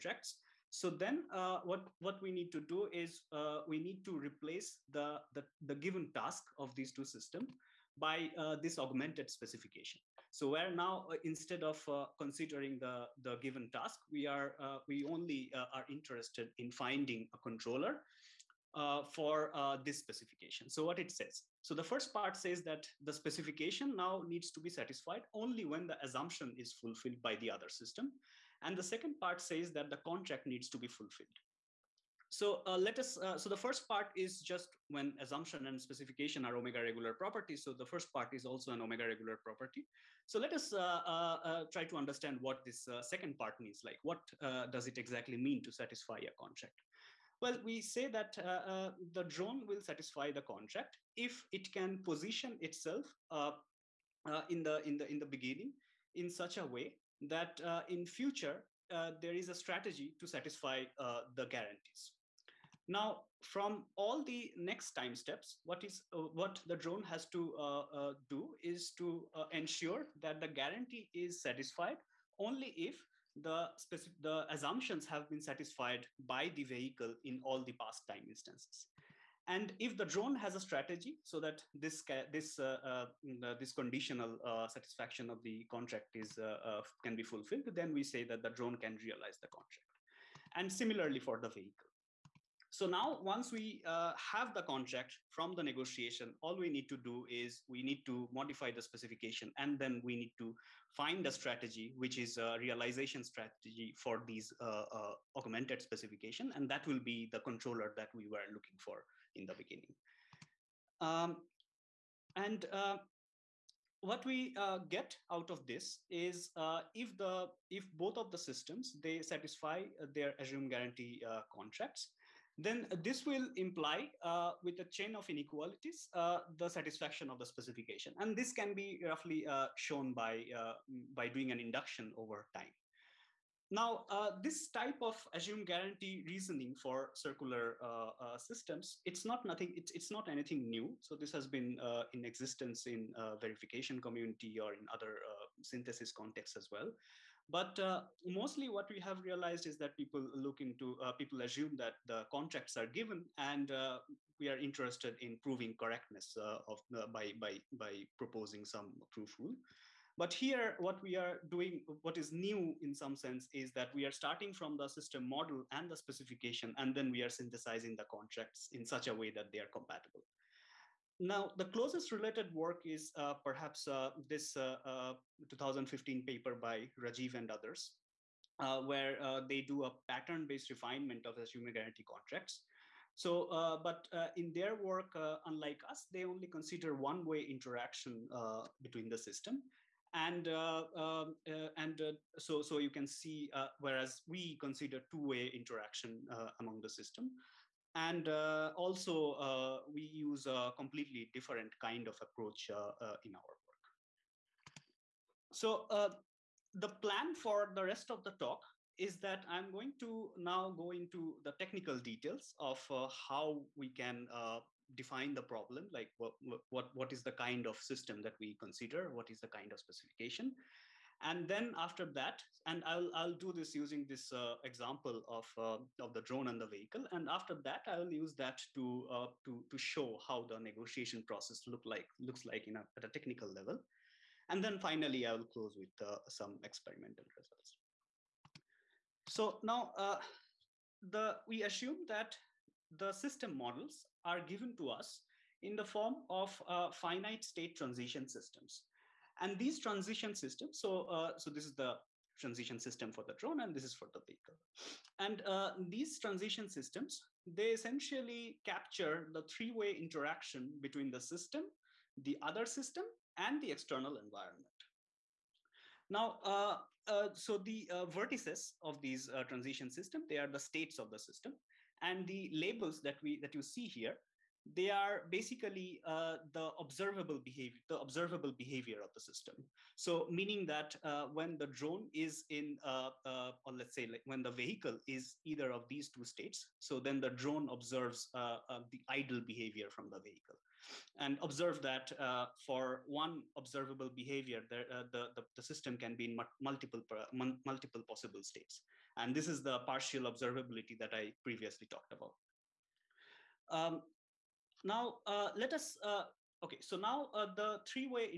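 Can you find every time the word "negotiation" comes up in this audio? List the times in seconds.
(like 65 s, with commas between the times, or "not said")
95 s, 230 s.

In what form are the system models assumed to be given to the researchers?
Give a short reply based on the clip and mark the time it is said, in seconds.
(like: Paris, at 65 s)
finite state transition systems, at 246 s.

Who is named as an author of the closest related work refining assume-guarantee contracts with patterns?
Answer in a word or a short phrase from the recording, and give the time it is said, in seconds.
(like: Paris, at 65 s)
Rajeev, at 176 s.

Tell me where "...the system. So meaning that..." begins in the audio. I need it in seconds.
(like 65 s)
279 s.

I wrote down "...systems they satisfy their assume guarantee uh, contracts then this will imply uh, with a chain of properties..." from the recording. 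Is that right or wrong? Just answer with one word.
wrong.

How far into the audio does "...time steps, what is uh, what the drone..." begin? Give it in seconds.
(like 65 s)
64 s.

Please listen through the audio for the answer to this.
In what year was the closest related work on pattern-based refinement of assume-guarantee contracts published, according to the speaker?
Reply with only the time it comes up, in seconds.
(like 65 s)
175 s.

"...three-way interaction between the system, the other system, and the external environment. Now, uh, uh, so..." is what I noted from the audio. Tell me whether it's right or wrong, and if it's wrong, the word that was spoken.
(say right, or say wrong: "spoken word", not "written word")
right.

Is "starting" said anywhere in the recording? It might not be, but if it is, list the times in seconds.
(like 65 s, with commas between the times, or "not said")
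164 s.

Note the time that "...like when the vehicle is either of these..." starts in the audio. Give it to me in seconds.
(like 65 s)
284 s.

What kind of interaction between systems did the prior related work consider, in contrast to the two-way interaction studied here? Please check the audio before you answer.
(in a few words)
one-way interaction.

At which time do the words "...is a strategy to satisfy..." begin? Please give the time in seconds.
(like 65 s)
59 s.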